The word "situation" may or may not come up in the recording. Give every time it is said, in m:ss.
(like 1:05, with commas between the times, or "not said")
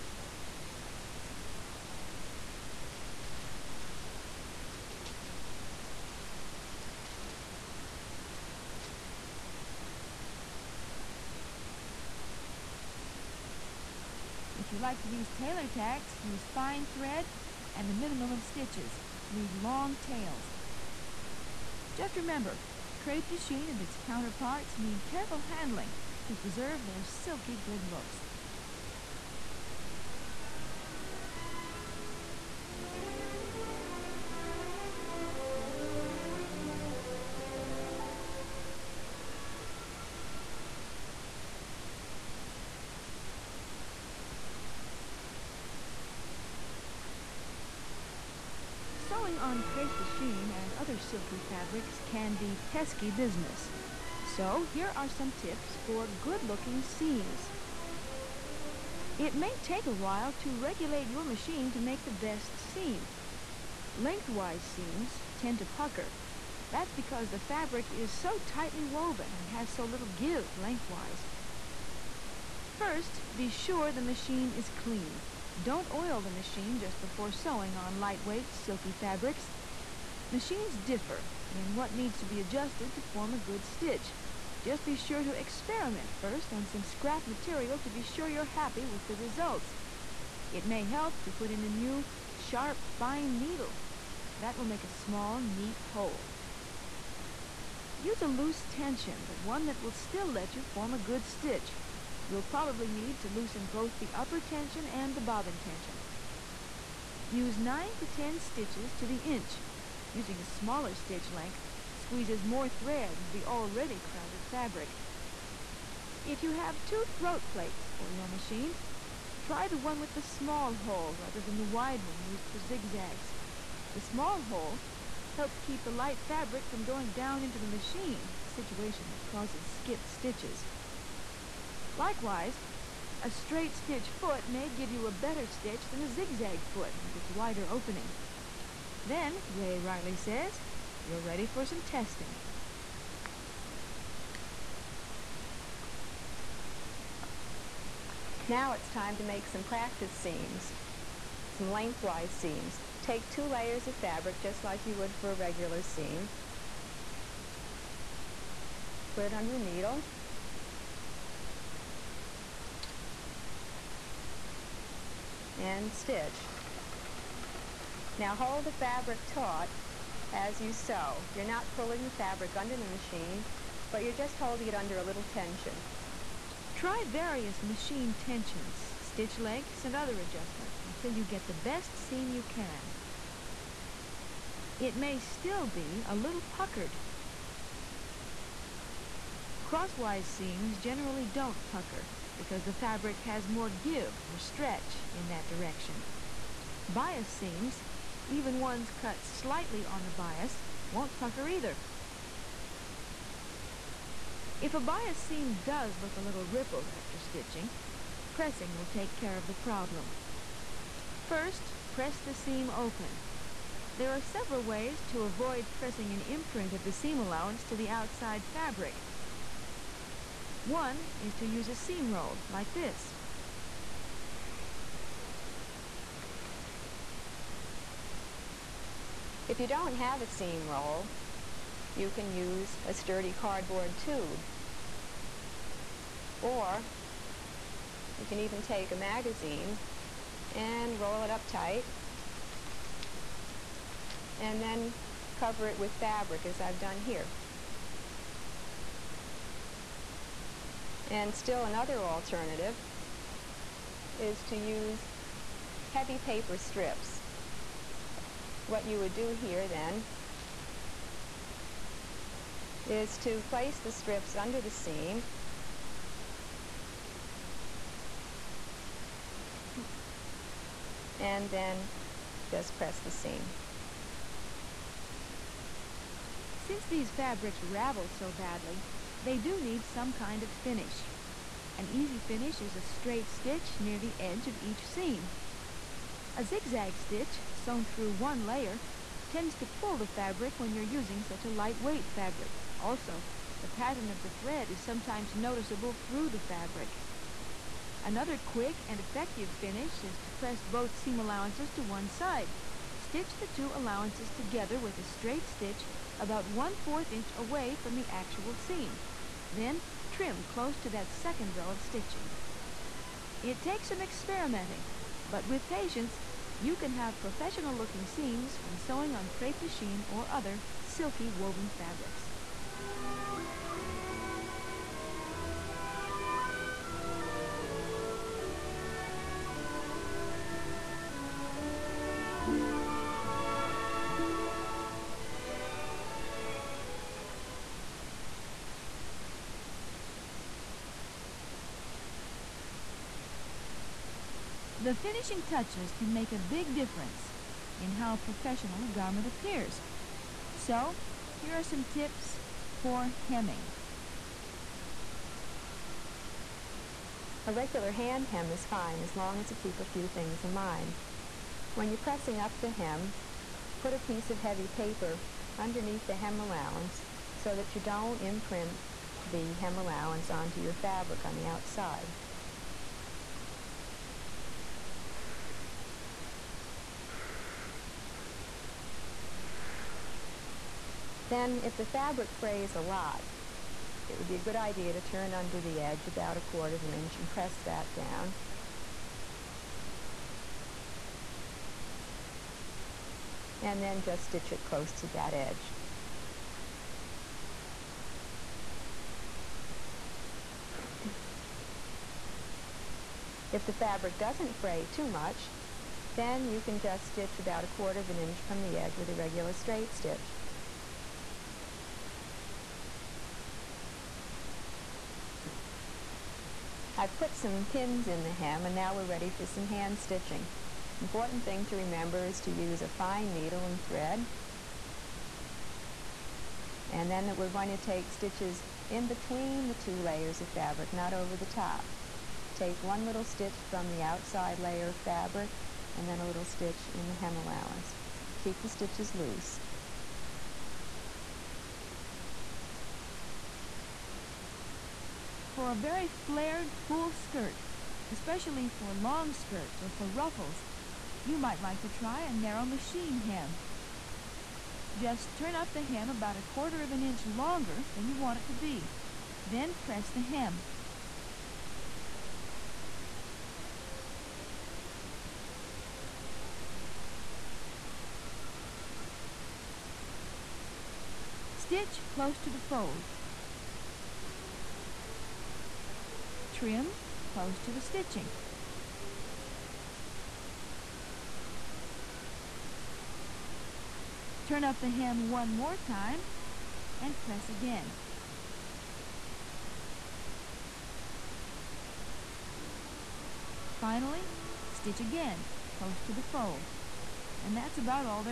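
2:08.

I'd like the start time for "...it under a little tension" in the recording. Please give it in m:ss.
2:54.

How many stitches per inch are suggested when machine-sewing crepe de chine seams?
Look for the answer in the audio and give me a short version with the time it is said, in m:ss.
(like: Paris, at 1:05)
9 to 10, at 1:47.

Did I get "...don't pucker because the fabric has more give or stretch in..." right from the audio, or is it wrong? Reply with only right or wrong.
right.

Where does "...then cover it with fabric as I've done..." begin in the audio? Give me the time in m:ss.
4:04.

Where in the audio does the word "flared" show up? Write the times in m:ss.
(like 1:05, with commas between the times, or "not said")
7:26.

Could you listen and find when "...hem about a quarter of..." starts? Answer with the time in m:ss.
7:35.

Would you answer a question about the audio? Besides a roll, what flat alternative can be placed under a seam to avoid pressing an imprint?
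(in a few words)
heavy paper strips.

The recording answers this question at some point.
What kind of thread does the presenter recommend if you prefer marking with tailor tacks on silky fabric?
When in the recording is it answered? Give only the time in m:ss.
0:16.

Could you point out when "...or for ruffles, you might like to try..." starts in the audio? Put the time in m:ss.
7:29.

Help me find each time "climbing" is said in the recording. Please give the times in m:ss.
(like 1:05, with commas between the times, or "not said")
not said.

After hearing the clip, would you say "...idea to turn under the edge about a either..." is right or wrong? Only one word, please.
wrong.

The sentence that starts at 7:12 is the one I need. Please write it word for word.
Take one little stitch from the outside layer of fabric and then a little stitch in the hem allowance.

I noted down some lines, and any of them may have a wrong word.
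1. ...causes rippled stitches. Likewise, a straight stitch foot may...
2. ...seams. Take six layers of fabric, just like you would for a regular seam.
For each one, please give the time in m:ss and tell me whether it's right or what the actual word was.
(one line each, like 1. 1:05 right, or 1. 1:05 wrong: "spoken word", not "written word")
1. 2:09 wrong: "skipped", not "rippled"
2. 2:32 wrong: "two", not "six".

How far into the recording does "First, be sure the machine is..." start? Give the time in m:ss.
1:12.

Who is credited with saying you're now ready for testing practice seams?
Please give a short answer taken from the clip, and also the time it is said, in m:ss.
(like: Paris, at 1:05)
Ray Riley, at 2:19.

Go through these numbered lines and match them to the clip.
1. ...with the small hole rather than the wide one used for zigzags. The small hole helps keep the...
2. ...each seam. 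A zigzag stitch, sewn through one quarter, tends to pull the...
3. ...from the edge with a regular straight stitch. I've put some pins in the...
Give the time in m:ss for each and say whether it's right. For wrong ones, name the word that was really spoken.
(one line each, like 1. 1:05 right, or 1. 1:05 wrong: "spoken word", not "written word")
1. 2:00 right
2. 4:44 wrong: "layer", not "quarter"
3. 6:48 right.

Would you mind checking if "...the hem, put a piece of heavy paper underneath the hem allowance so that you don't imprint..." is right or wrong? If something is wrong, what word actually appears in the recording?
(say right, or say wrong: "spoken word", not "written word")
right.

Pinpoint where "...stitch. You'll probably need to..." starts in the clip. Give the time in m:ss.
1:41.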